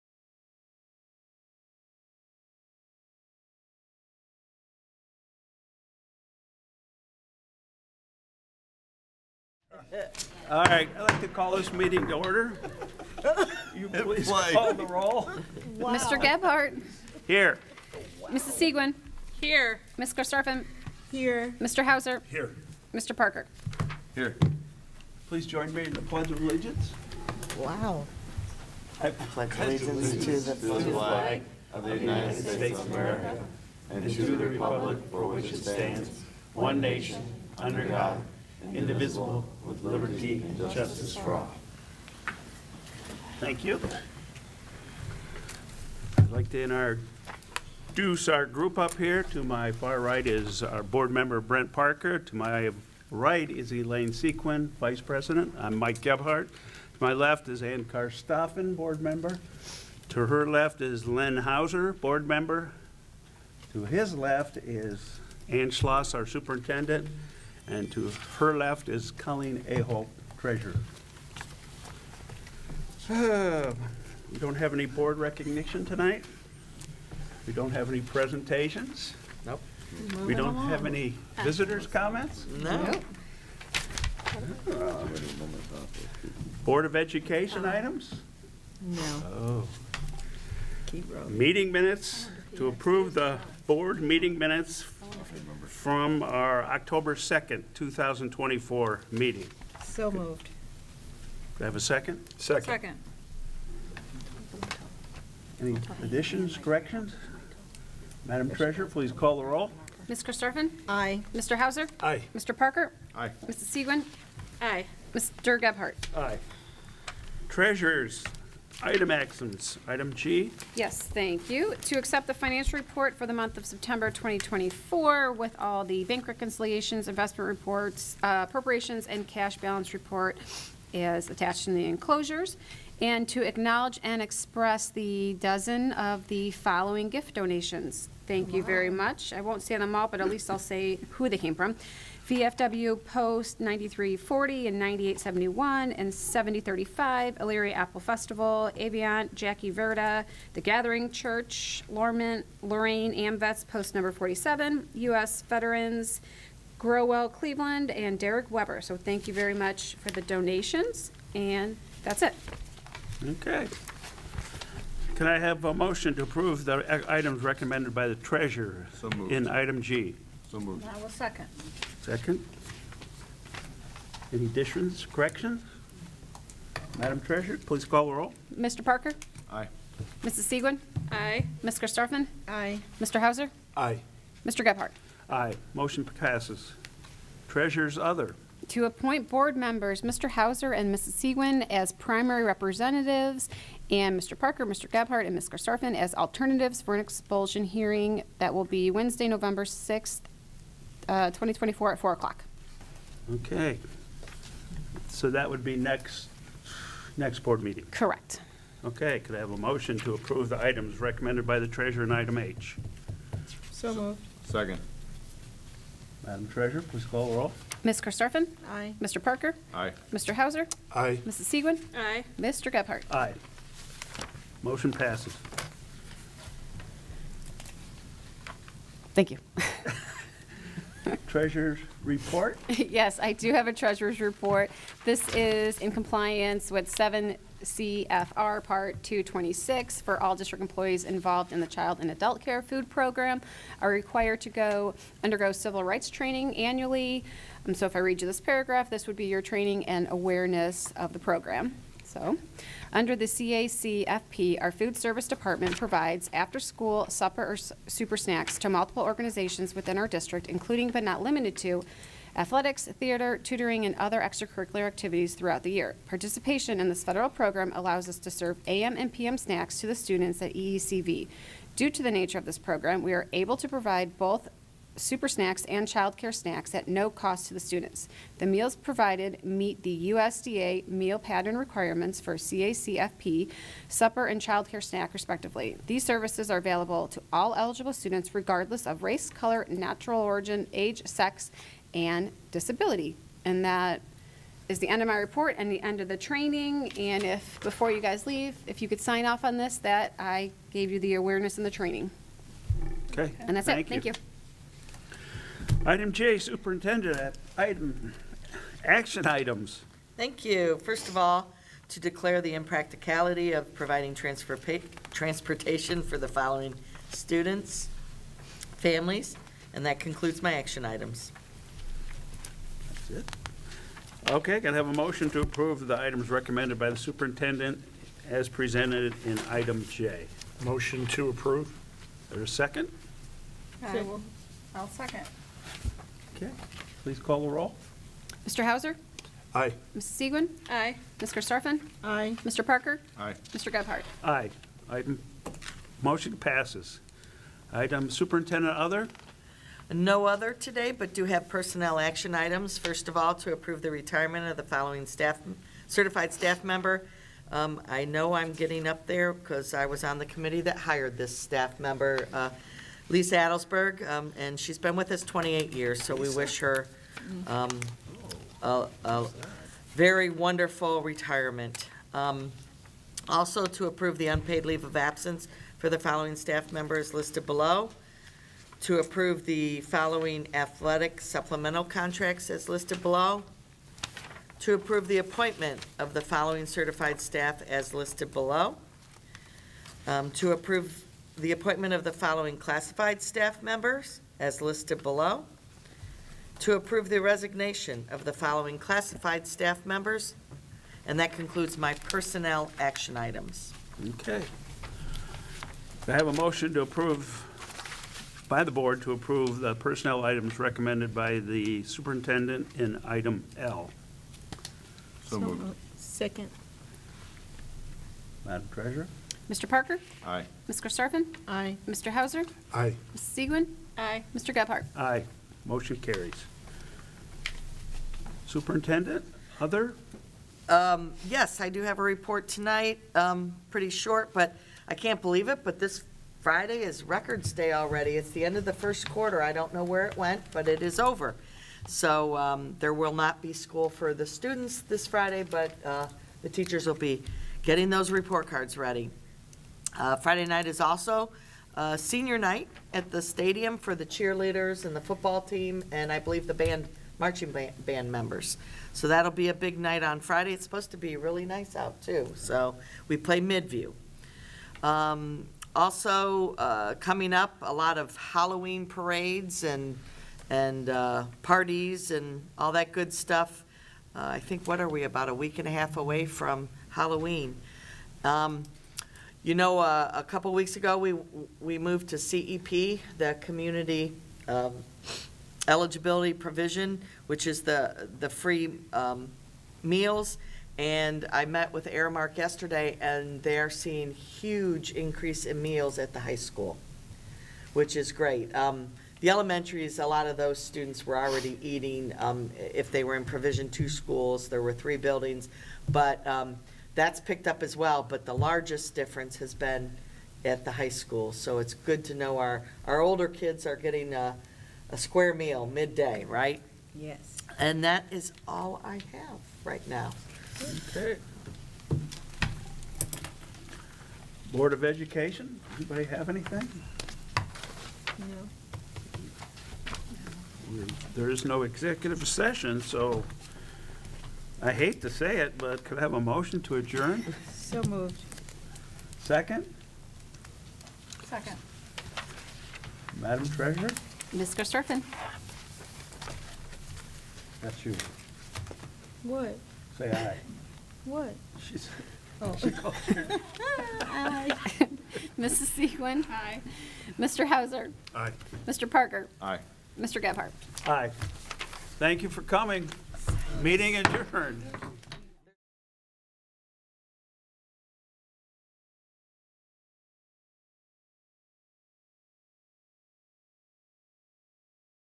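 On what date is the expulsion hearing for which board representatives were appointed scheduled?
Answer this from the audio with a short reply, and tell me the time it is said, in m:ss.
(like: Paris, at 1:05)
November 6th, at 3:19.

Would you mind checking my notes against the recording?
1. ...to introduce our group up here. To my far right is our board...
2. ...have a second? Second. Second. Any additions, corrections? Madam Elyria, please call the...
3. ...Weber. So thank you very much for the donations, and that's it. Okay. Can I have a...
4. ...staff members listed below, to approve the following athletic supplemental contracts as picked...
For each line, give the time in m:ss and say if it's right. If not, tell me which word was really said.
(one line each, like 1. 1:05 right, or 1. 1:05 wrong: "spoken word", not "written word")
1. 0:46 right
2. 1:41 wrong: "Treasurer", not "Elyria"
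3. 2:38 right
4. 6:16 wrong: "listed", not "picked".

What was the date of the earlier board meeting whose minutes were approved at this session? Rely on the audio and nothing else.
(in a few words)
October 2nd, 2024.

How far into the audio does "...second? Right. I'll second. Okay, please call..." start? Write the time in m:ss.
5:32.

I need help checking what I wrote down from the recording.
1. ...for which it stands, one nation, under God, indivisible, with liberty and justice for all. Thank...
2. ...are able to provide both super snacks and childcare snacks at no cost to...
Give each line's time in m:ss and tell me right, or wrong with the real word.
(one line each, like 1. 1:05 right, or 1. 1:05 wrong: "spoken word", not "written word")
1. 0:35 right
2. 4:33 right.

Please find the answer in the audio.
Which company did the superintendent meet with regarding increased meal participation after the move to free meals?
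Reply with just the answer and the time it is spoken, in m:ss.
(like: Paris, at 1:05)
Aramark, at 8:11.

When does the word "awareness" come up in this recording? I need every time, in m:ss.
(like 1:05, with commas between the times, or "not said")
4:10, 5:01.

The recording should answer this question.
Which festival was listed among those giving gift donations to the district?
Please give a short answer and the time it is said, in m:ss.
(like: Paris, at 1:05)
Elyria Apple Festival, at 2:27.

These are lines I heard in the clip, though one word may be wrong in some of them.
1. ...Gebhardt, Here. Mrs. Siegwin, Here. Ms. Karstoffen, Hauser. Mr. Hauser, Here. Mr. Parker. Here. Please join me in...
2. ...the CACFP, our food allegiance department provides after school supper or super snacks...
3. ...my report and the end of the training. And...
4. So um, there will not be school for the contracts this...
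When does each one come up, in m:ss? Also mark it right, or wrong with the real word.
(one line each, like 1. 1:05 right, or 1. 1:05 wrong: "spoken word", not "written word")
1. 0:16 wrong: "Here", not "Hauser"
2. 4:13 wrong: "service", not "allegiance"
3. 4:55 right
4. 7:21 wrong: "students", not "contracts".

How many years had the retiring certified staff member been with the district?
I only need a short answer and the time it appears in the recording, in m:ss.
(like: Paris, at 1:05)
28, at 6:05.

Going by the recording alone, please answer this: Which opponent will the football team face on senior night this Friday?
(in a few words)
Midview.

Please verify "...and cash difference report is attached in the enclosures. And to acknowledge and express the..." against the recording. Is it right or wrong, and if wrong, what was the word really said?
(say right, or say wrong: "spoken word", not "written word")
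wrong: "balance", not "difference".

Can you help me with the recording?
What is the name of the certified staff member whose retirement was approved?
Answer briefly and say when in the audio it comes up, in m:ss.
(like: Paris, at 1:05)
Lisa Adelsberg, at 6:03.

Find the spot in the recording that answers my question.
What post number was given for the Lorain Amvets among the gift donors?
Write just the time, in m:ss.
2:34.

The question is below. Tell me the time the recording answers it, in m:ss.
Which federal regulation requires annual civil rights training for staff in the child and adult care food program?
3:56.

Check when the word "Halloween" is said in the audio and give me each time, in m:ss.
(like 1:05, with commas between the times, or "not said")
7:48, 7:56.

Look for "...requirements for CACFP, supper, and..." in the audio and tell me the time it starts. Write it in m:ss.
4:41.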